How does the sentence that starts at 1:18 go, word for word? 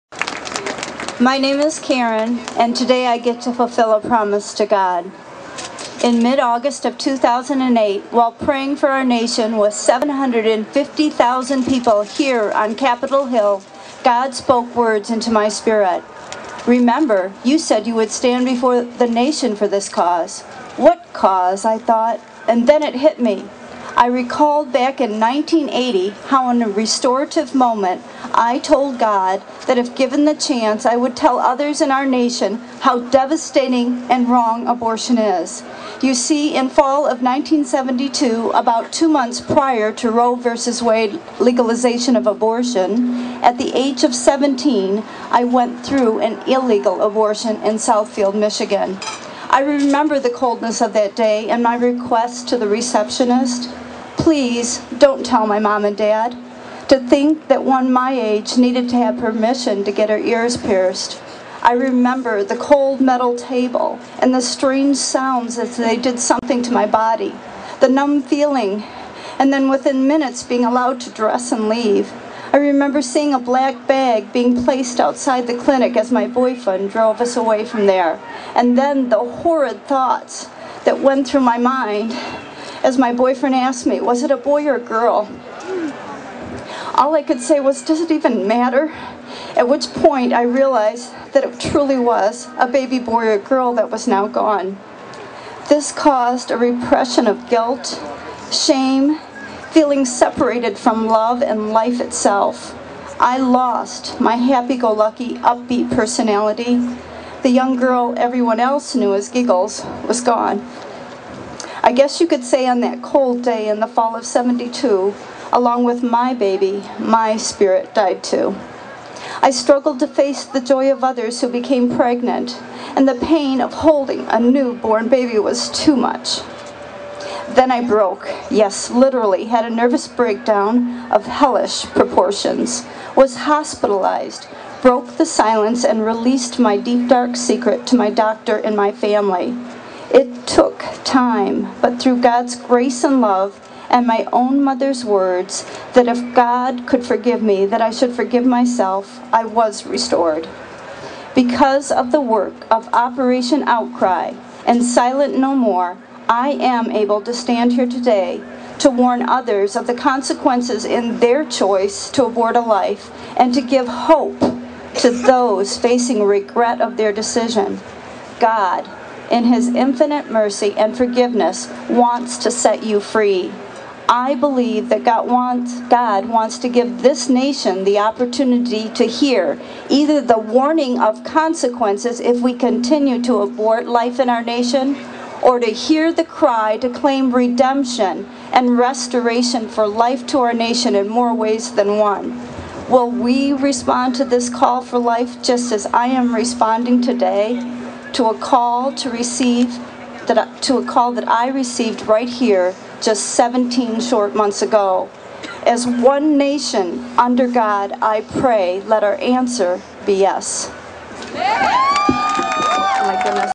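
And then the horrid thoughts that went through my mind as my boyfriend asked me, was it a boy or a girl?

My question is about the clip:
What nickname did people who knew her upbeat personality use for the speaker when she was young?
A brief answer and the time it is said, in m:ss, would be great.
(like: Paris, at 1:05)
Giggles, at 1:49.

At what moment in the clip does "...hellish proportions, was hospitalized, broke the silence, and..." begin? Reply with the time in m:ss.
2:11.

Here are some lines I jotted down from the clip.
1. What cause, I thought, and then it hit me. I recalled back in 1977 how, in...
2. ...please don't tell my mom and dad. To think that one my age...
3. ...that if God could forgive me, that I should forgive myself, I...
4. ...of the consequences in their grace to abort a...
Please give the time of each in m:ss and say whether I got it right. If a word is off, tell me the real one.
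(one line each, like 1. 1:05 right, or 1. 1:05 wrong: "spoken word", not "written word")
1. 0:20 wrong: "1980", not "1977"
2. 0:54 right
3. 2:25 right
4. 2:39 wrong: "choice", not "grace".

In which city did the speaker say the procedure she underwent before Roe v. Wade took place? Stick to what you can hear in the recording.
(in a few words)
Southfield, Michigan.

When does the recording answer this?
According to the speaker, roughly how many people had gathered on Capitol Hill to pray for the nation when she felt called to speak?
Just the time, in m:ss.
0:09.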